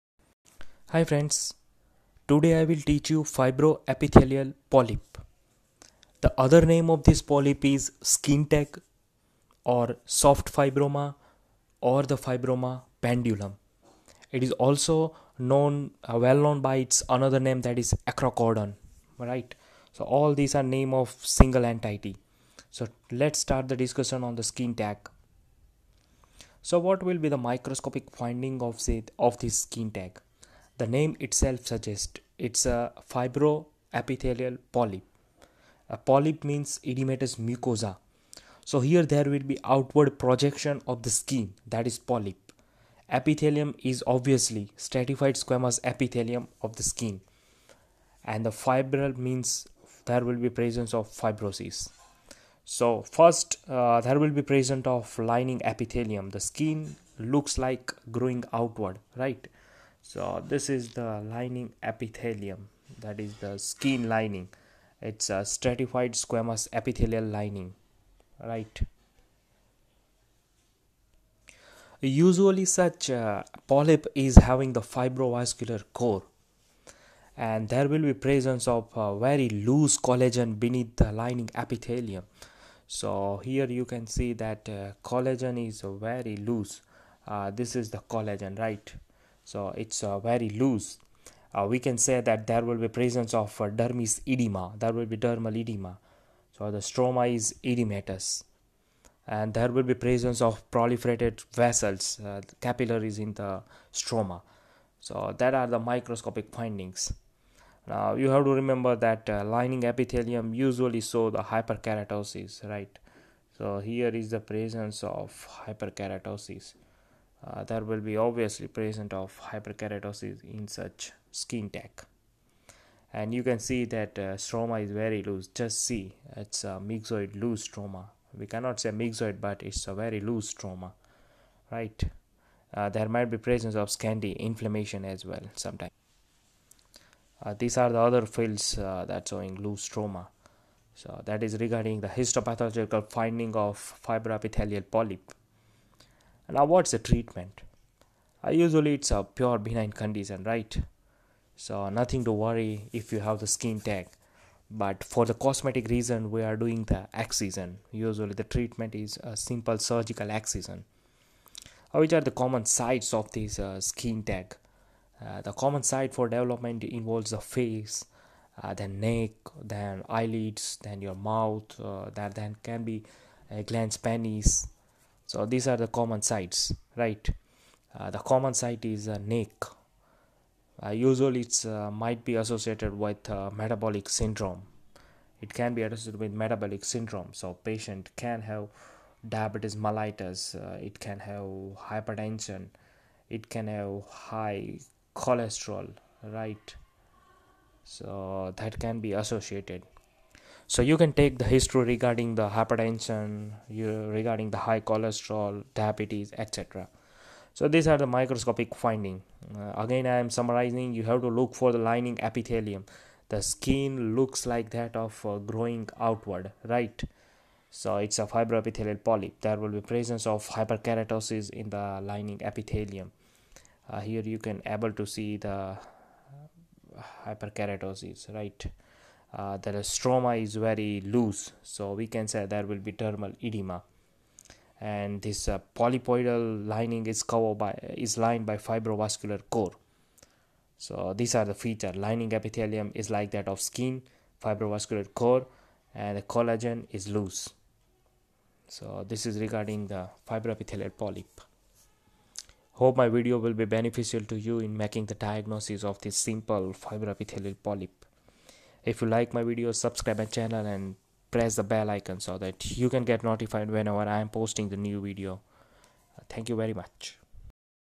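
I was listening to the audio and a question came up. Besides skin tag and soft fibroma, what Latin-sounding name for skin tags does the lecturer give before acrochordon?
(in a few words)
fibroma pendulum.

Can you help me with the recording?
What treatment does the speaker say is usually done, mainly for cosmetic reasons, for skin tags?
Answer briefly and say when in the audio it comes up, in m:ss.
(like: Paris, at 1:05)
simple surgical excision, at 2:39.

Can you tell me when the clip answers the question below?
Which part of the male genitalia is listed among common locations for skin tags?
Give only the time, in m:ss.
2:53.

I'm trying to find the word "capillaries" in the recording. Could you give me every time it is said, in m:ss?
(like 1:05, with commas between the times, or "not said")
1:42.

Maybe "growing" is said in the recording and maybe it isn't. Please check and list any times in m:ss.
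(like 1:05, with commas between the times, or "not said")
0:58, 3:35.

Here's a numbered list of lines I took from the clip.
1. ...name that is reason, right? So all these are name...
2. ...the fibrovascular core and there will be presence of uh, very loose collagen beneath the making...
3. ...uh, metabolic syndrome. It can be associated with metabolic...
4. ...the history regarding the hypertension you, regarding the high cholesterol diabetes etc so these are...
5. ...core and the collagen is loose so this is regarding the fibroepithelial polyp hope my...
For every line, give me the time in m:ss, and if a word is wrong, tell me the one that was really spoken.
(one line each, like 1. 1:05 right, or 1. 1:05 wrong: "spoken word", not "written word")
1. 0:17 wrong: "acrochordon", not "reason"
2. 1:14 wrong: "lining", not "making"
3. 3:03 right
4. 3:21 right
5. 4:05 right.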